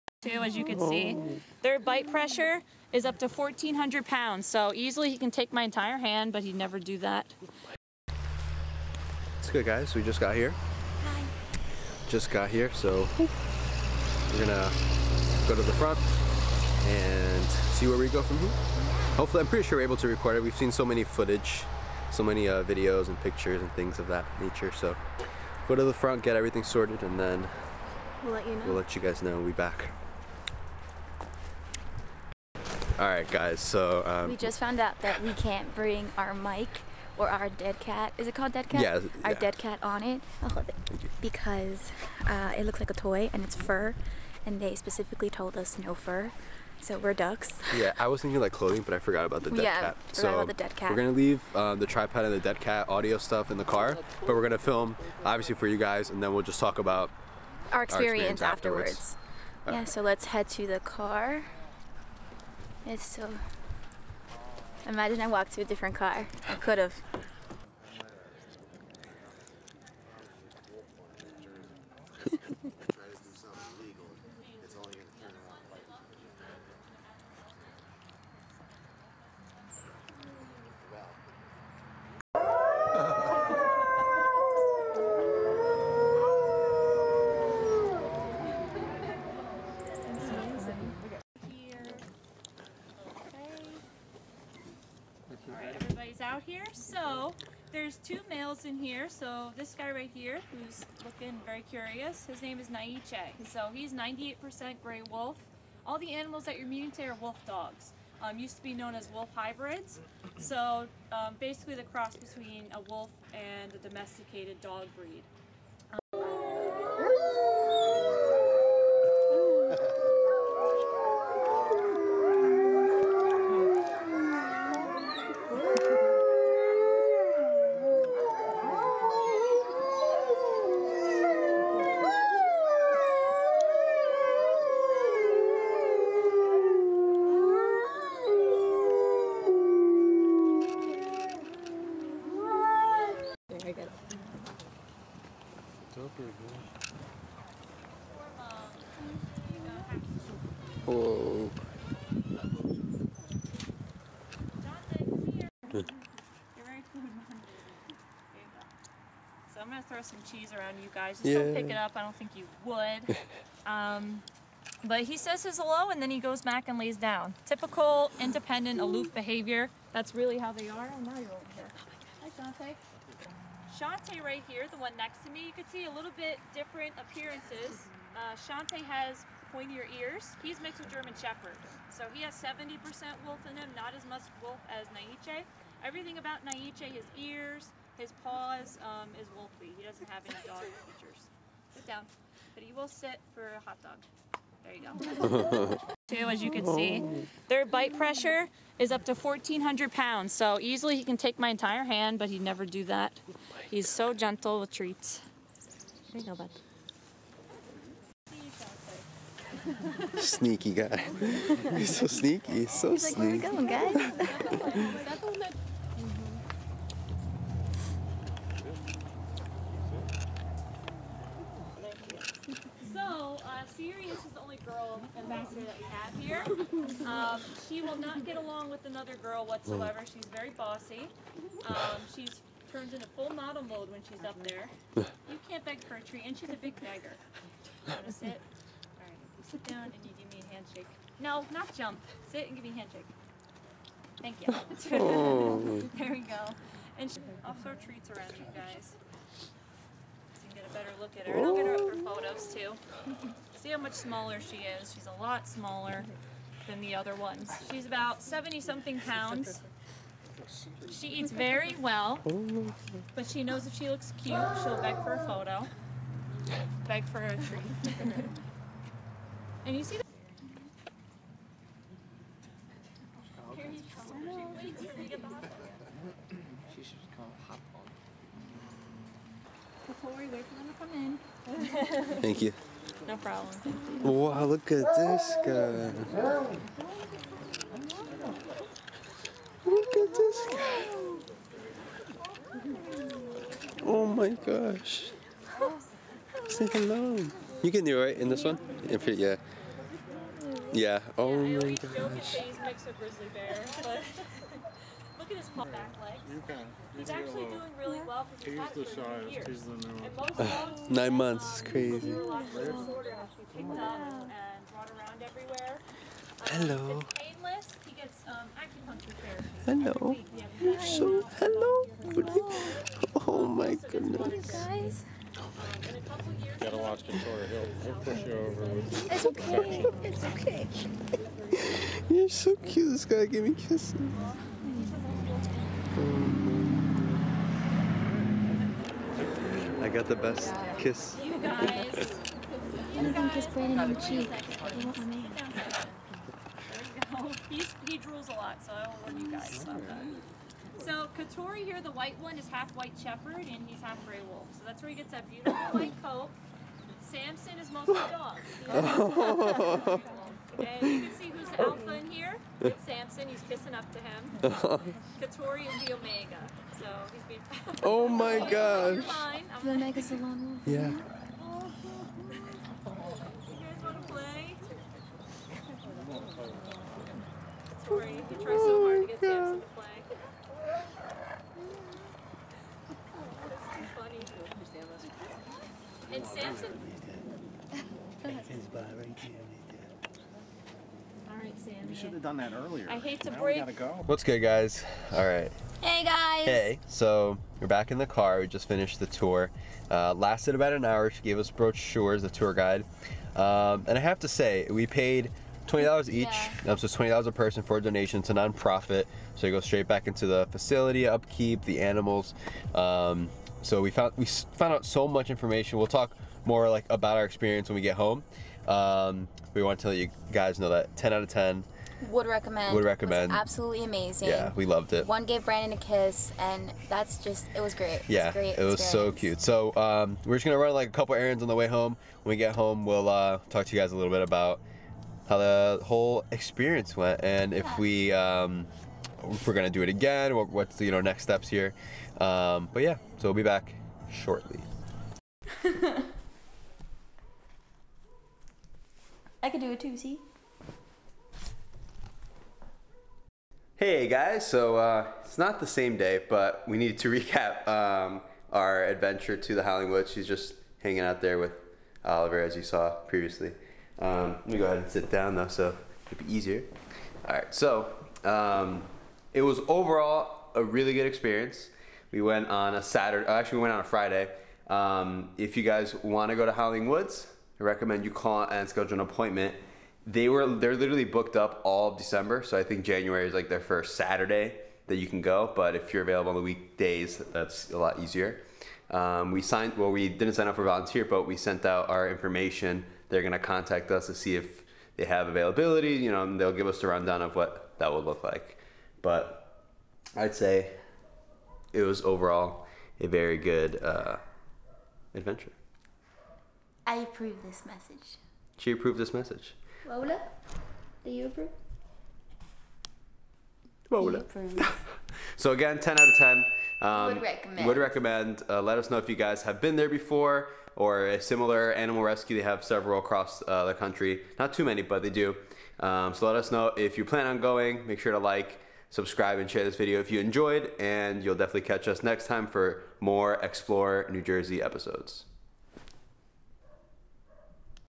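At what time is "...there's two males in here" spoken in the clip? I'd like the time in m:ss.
1:37.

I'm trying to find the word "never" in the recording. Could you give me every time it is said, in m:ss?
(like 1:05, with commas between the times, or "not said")
0:06, 3:22.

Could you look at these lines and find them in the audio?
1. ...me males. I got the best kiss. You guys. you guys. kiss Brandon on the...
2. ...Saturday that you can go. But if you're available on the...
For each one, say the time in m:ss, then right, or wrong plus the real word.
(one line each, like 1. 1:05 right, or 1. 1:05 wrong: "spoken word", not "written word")
1. 5:33 wrong: "kisses", not "males"
2. 8:03 right.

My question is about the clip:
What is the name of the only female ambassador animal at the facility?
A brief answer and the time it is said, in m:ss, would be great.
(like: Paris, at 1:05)
Sirius, at 3:43.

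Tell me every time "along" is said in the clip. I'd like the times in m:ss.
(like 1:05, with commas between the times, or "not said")
3:48.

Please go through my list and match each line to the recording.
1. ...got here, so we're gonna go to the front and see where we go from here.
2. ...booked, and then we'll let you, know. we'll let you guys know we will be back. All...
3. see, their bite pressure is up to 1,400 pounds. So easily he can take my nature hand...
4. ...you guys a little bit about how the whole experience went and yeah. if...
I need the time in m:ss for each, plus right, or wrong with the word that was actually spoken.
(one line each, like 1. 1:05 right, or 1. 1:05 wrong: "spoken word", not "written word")
1. 0:12 right
2. 0:26 wrong: "sorted", not "booked"
3. 3:16 wrong: "entire", not "nature"
4. 7:13 right.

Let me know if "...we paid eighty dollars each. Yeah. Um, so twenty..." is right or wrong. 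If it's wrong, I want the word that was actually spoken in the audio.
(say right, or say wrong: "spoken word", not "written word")
wrong: "twenty", not "eighty".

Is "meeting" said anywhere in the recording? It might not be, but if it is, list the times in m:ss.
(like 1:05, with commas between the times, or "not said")
1:46.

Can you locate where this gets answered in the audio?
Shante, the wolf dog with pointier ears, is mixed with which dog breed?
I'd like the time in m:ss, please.
3:00.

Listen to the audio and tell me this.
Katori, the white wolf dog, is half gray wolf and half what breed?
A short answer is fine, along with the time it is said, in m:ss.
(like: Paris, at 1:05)
White shepherd, at 5:52.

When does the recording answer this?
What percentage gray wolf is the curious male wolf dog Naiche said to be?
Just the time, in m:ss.
1:43.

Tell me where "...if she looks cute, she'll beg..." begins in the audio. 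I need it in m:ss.
4:23.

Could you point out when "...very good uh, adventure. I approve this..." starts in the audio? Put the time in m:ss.
8:23.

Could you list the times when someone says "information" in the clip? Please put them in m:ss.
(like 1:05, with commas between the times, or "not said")
6:55, 8:12.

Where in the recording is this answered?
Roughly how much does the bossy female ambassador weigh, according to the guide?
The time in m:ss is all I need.
4:18.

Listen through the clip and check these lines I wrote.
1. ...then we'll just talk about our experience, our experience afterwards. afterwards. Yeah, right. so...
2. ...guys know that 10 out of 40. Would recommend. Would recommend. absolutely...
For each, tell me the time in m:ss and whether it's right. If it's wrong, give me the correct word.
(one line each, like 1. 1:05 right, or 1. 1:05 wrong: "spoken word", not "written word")
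1. 0:56 right
2. 7:00 wrong: "10", not "40".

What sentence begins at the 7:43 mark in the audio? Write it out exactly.
Um, let me go ahead and sit down though, so it'd be easier.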